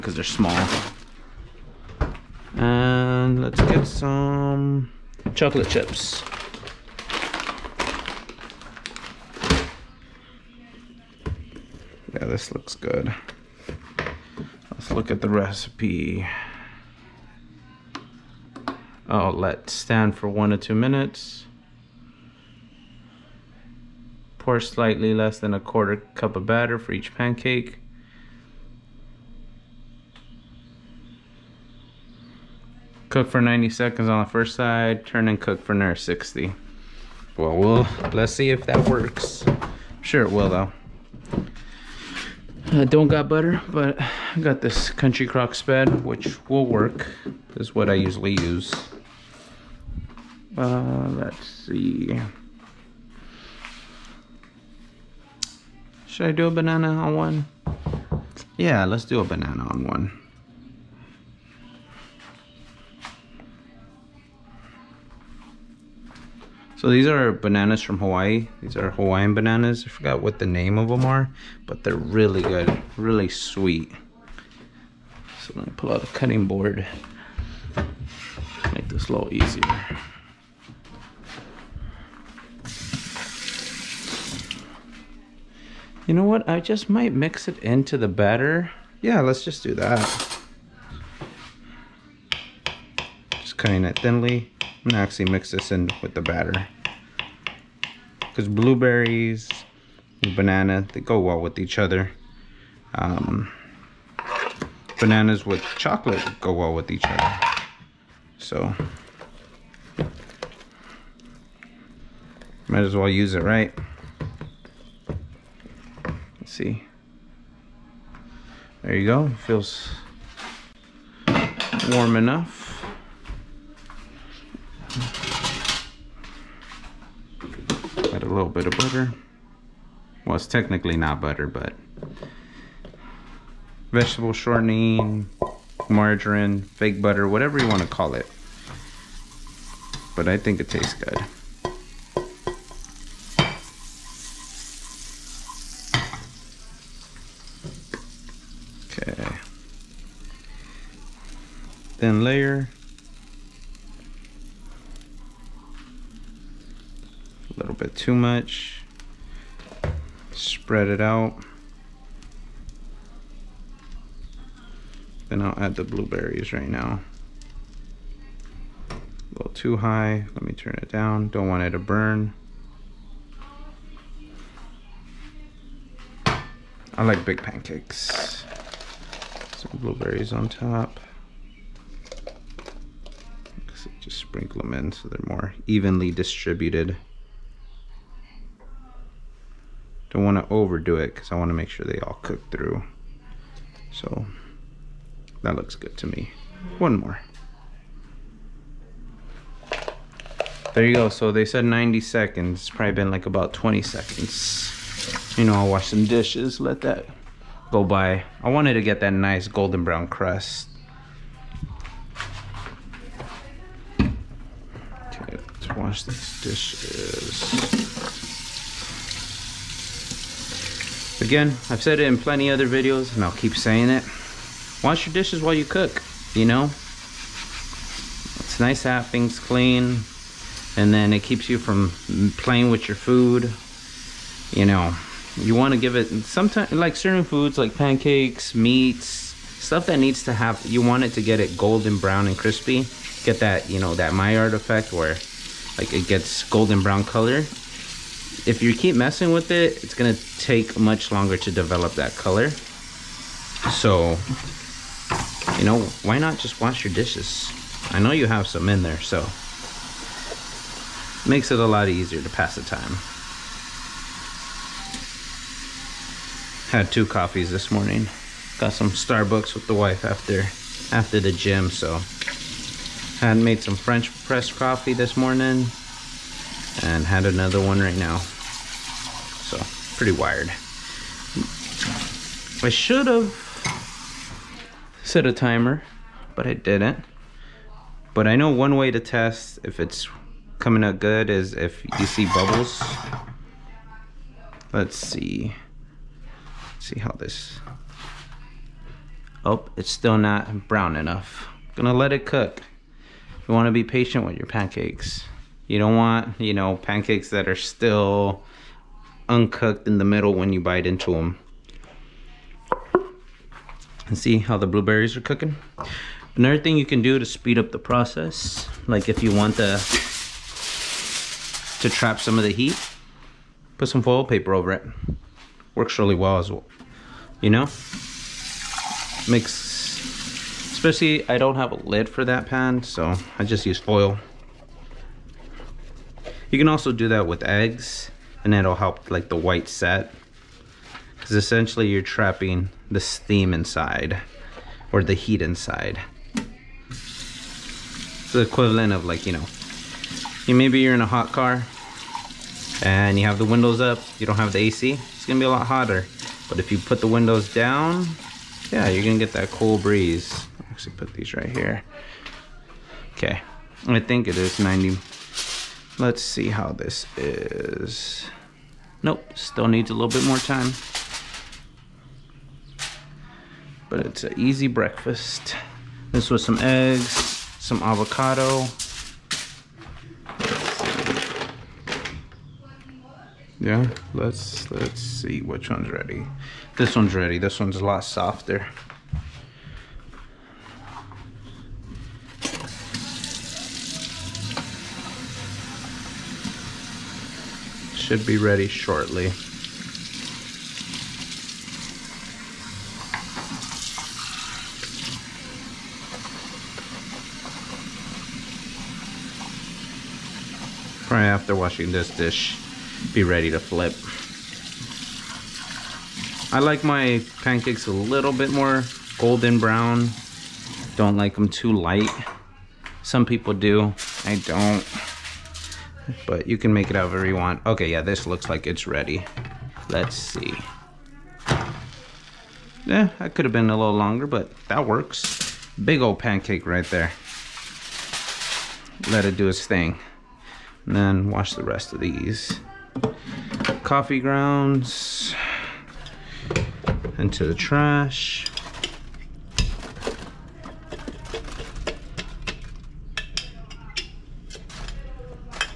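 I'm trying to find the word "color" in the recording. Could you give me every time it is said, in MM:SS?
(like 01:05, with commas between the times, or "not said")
04:07, 04:12.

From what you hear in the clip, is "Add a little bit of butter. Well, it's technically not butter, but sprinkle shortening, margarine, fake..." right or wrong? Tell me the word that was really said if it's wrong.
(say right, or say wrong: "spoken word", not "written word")
wrong: "vegetable", not "sprinkle".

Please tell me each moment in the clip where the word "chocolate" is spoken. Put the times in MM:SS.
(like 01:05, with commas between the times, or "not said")
00:05, 01:45.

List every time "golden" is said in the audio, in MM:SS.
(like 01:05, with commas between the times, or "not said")
03:29, 04:01, 04:06, 06:59.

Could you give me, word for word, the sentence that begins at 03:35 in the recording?
Wash this dish Again, I've said it in plenty other videos, and I'll keep saying it.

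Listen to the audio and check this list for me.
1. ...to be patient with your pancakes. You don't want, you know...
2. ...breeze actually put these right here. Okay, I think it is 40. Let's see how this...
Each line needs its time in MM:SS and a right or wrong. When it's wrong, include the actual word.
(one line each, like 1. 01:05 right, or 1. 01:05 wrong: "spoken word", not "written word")
1. 05:03 right
2. 05:59 wrong: "90", not "40".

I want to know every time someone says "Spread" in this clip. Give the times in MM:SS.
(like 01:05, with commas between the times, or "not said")
00:45, 02:40.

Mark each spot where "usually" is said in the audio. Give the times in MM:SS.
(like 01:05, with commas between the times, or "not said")
00:47.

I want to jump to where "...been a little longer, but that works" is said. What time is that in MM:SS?
07:13.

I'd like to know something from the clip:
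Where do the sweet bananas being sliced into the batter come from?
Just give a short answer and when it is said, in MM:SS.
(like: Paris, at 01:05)
Hawaii, at 01:07.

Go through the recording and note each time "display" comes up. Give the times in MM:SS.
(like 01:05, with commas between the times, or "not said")
not said.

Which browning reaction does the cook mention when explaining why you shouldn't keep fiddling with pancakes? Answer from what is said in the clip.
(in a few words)
Maillard effect.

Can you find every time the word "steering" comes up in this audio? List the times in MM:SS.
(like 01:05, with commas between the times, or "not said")
not said.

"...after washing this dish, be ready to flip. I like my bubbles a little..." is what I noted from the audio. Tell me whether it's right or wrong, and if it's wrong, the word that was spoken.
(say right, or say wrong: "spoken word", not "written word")
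wrong: "pancakes", not "bubbles".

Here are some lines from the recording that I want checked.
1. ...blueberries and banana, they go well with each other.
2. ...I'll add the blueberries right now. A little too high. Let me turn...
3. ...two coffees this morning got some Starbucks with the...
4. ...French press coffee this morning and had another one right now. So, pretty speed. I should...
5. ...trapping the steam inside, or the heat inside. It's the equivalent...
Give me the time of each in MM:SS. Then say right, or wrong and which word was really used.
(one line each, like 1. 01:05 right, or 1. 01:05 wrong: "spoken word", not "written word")
1. 01:38 right
2. 02:45 right
3. 04:26 right
4. 04:33 wrong: "wired", not "speed"
5. 05:42 right.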